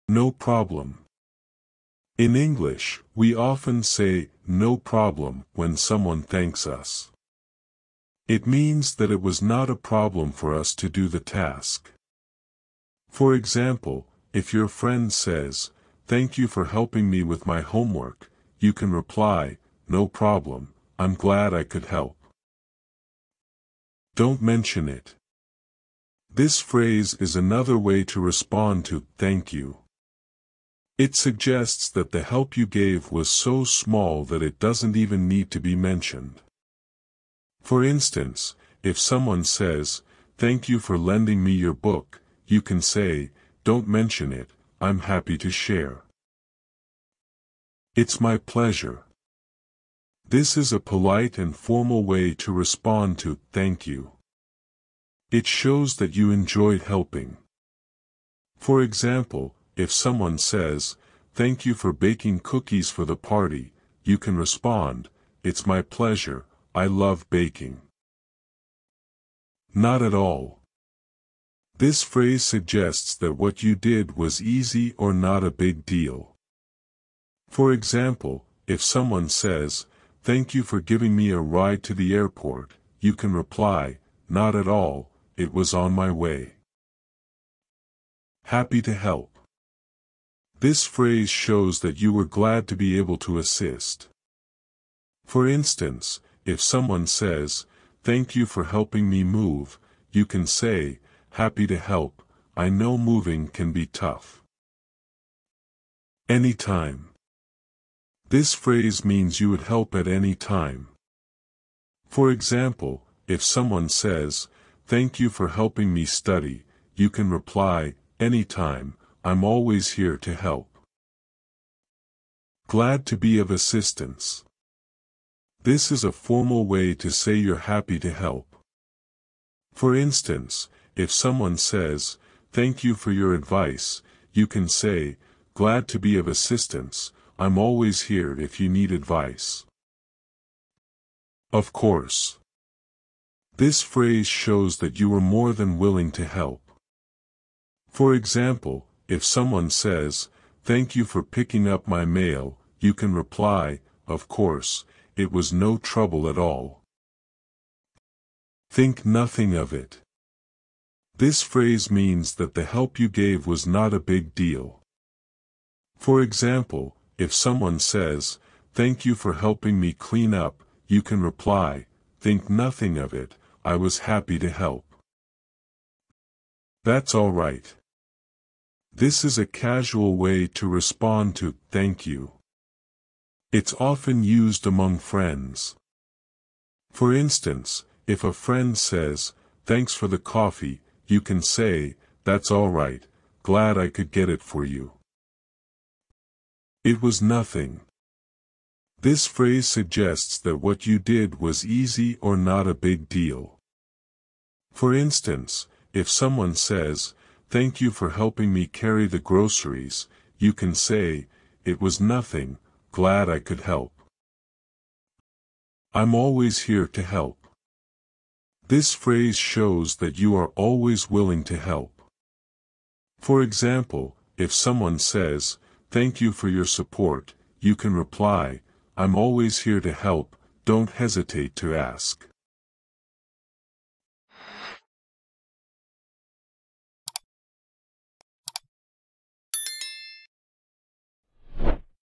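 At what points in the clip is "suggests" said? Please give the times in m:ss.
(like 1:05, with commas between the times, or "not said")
0:31, 1:12, 3:19.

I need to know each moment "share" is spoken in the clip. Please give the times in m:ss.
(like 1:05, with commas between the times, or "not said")
0:45.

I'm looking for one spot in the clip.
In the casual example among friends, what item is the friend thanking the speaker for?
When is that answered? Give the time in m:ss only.
3:10.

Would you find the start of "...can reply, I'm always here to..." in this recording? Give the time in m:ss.
3:47.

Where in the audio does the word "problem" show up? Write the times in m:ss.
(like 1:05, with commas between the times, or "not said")
0:00, 0:04, 0:09, 0:20.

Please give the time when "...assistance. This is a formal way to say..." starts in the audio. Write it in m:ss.
2:03.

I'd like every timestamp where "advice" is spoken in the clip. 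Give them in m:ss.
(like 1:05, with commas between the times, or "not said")
2:13, 2:18.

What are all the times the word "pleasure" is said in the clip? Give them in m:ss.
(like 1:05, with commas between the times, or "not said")
0:48, 1:05.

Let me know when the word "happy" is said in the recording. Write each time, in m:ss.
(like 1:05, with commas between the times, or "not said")
0:44, 1:28, 1:41, 2:07, 2:54.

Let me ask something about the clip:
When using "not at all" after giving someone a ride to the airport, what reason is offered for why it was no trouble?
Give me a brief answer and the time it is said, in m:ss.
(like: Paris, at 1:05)
It was on my way, at 1:25.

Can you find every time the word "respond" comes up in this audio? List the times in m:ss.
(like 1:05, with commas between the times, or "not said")
0:28, 0:52, 1:04, 3:00.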